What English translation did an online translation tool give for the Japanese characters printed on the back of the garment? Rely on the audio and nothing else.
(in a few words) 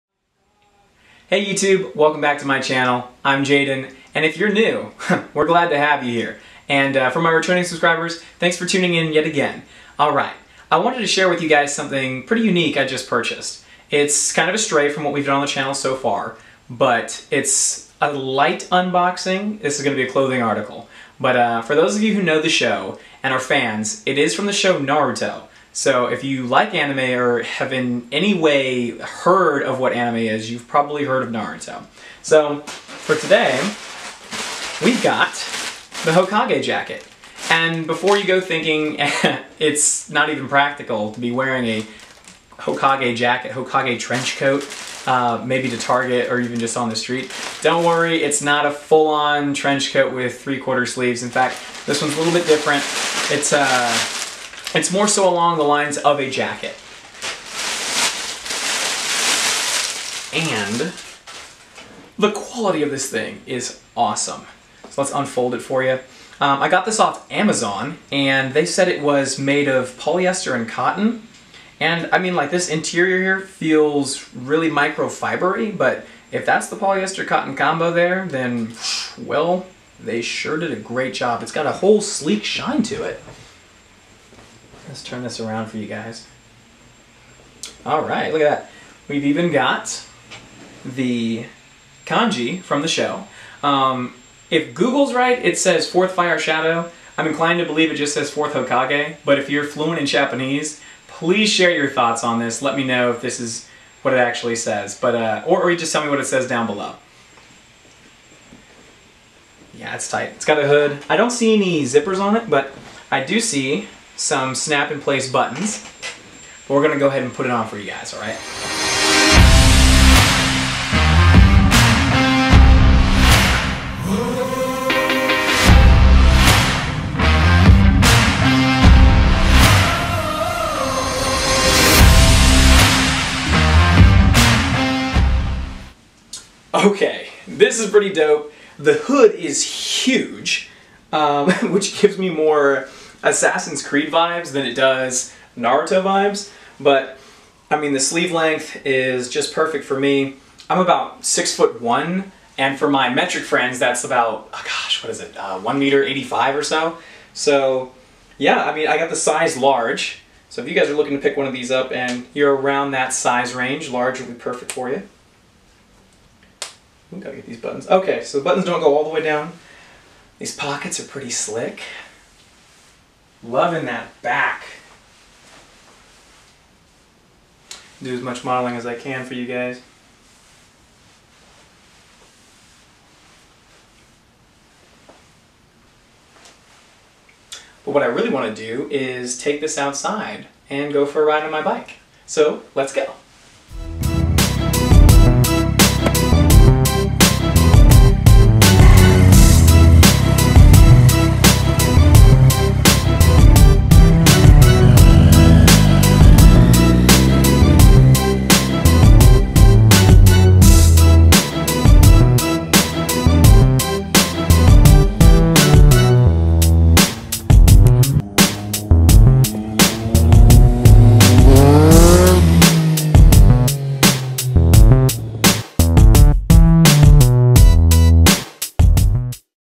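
fourth fire shadow.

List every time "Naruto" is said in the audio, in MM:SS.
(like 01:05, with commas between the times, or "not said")
00:24, 00:31, 02:25.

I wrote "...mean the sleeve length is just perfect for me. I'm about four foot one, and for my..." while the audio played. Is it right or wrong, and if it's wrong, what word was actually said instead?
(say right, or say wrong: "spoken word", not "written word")
wrong: "six", not "four".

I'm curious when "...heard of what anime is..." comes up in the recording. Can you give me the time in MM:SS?
00:28.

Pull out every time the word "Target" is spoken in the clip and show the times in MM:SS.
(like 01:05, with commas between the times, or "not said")
00:45.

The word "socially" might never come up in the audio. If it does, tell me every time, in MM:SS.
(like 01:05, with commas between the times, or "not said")
not said.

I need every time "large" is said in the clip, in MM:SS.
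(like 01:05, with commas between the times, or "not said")
02:39, 02:43.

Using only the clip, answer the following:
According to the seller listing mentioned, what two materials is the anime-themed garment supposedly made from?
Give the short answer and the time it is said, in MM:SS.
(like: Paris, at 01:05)
polyester and cotton, at 01:09.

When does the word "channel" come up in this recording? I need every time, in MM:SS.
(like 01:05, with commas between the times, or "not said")
00:02, 00:15.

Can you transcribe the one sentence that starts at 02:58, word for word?
Do as much modeling as I can for you guys.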